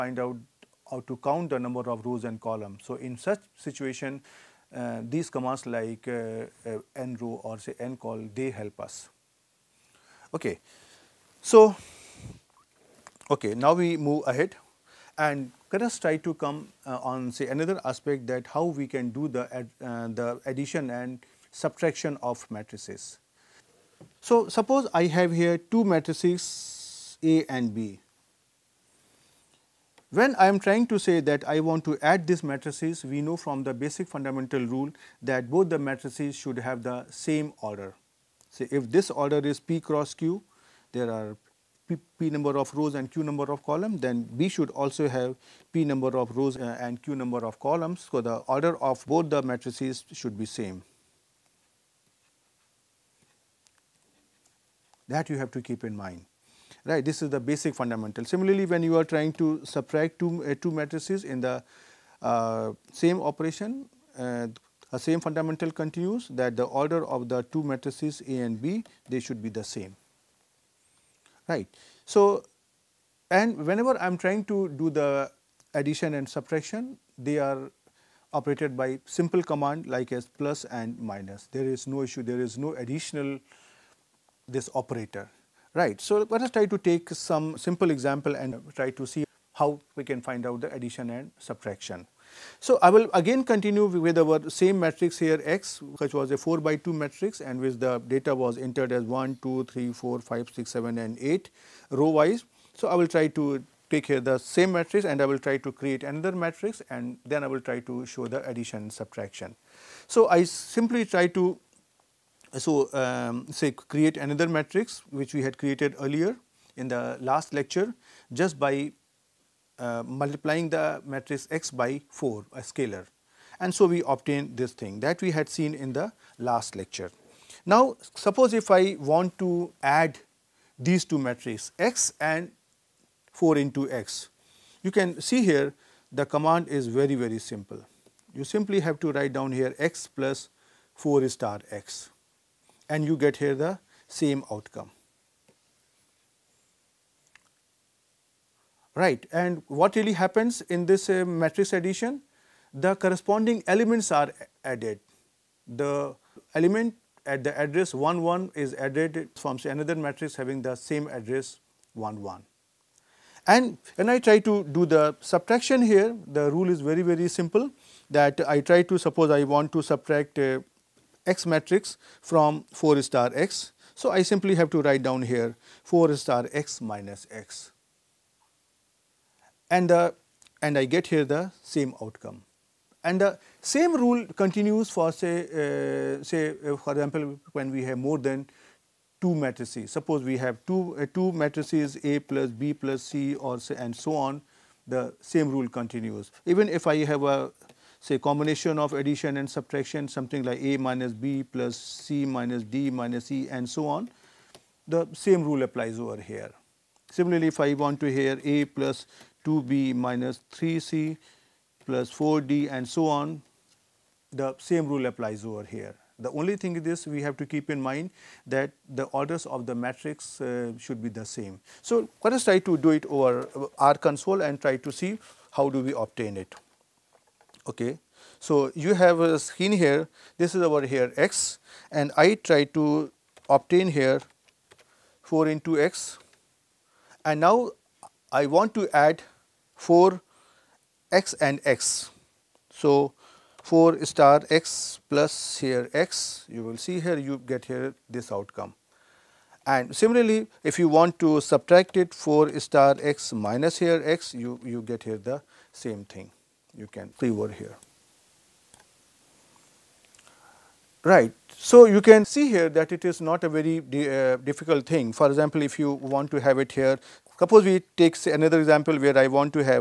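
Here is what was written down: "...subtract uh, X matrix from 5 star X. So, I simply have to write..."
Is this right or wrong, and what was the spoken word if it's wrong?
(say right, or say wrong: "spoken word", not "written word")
wrong: "4", not "5".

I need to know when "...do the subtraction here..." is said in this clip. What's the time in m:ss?
2:44.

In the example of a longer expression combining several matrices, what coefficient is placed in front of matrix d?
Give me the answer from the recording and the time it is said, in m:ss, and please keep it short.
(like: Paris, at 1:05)
4, at 3:32.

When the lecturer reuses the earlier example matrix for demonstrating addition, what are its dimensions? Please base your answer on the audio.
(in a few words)
4 by 2.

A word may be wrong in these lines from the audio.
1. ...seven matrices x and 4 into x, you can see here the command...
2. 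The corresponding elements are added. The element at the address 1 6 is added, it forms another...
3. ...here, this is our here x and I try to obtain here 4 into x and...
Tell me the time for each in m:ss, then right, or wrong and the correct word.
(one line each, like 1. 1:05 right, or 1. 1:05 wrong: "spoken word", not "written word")
1. 2:11 wrong: "two", not "seven"
2. 2:32 wrong: "1", not "6"
3. 3:49 right.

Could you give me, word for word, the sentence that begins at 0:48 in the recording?
So, the order of both the matrices should be same.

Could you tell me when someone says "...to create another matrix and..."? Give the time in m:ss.
1:45.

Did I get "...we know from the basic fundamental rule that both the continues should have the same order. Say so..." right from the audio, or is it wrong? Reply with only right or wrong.
wrong.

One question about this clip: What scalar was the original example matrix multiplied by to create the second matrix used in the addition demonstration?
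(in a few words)
4.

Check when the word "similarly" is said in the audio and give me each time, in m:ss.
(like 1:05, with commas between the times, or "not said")
0:58, 3:27, 4:09.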